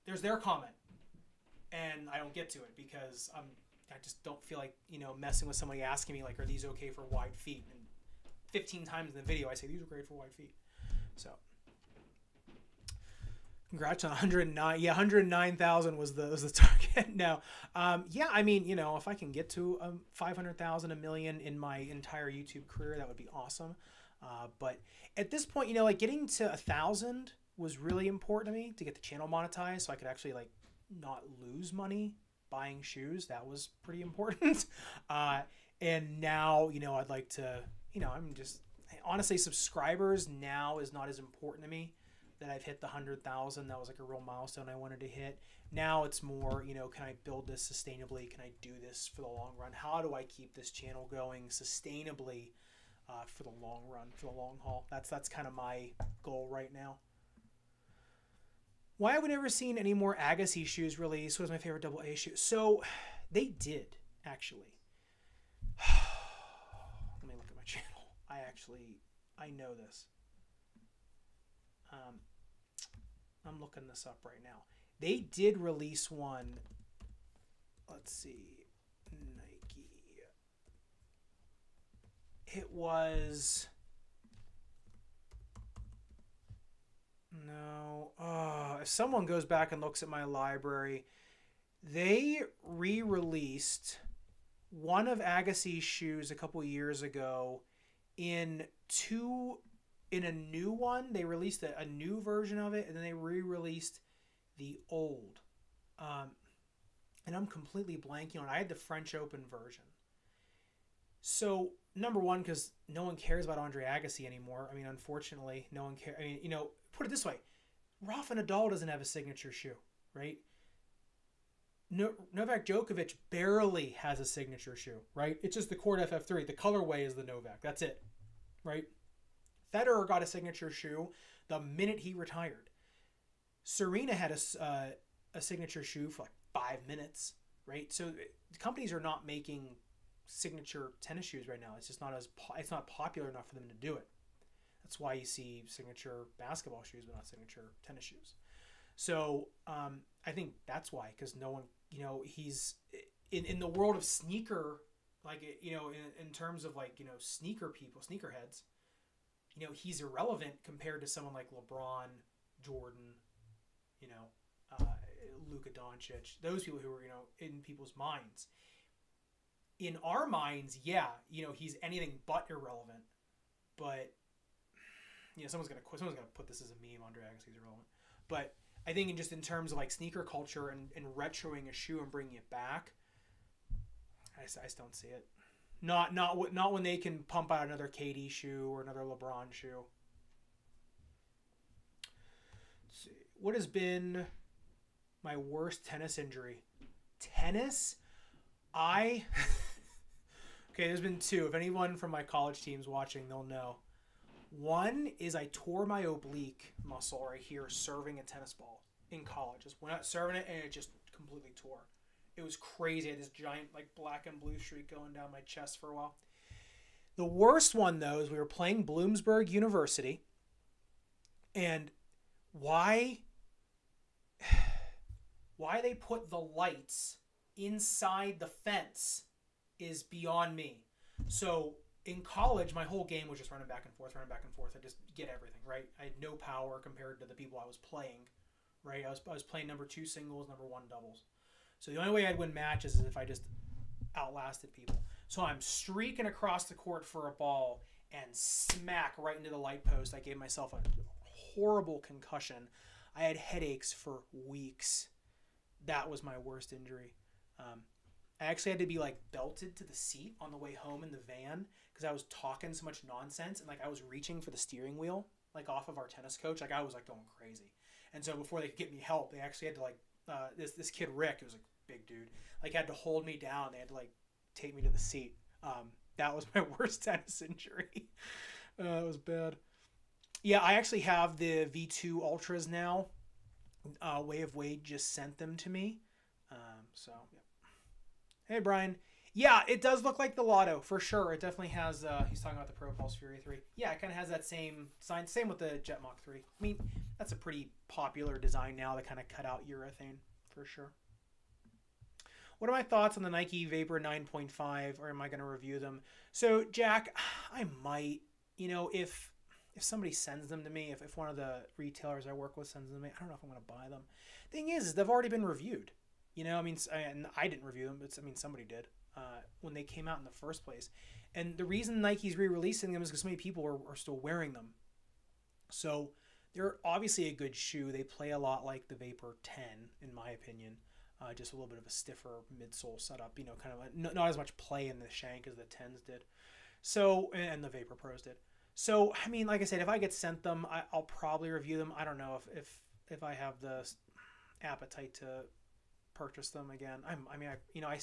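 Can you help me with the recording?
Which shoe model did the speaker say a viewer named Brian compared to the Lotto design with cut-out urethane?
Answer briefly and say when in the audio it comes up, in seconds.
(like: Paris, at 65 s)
Propulse Fury 3, at 292 s.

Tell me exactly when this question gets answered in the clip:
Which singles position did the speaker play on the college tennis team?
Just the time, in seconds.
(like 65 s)
239 s.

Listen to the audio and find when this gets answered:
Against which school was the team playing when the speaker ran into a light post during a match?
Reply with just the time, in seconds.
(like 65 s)
218 s.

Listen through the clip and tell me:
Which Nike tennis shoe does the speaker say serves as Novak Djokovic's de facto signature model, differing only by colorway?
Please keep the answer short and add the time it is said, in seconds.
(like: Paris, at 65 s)
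Court FF3, at 125 s.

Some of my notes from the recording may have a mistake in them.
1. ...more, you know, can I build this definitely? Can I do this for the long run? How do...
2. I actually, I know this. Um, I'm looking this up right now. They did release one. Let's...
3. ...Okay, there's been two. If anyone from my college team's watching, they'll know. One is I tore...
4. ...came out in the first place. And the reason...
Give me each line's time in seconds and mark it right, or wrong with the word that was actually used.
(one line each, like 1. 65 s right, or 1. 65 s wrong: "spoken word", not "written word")
1. 46 s wrong: "sustainably", not "definitely"
2. 68 s right
3. 200 s right
4. 319 s right.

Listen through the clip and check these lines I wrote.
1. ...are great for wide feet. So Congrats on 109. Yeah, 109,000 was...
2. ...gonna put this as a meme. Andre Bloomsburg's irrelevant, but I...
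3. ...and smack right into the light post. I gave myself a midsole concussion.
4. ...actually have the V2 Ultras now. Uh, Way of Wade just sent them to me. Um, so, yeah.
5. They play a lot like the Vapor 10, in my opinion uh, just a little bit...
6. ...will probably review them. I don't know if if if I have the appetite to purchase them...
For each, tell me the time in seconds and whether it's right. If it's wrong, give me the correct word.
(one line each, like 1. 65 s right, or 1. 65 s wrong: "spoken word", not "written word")
1. 9 s right
2. 176 s wrong: "Agassi", not "Bloomsburg"
3. 248 s wrong: "horrible", not "midsole"
4. 280 s right
5. 327 s right
6. 340 s right.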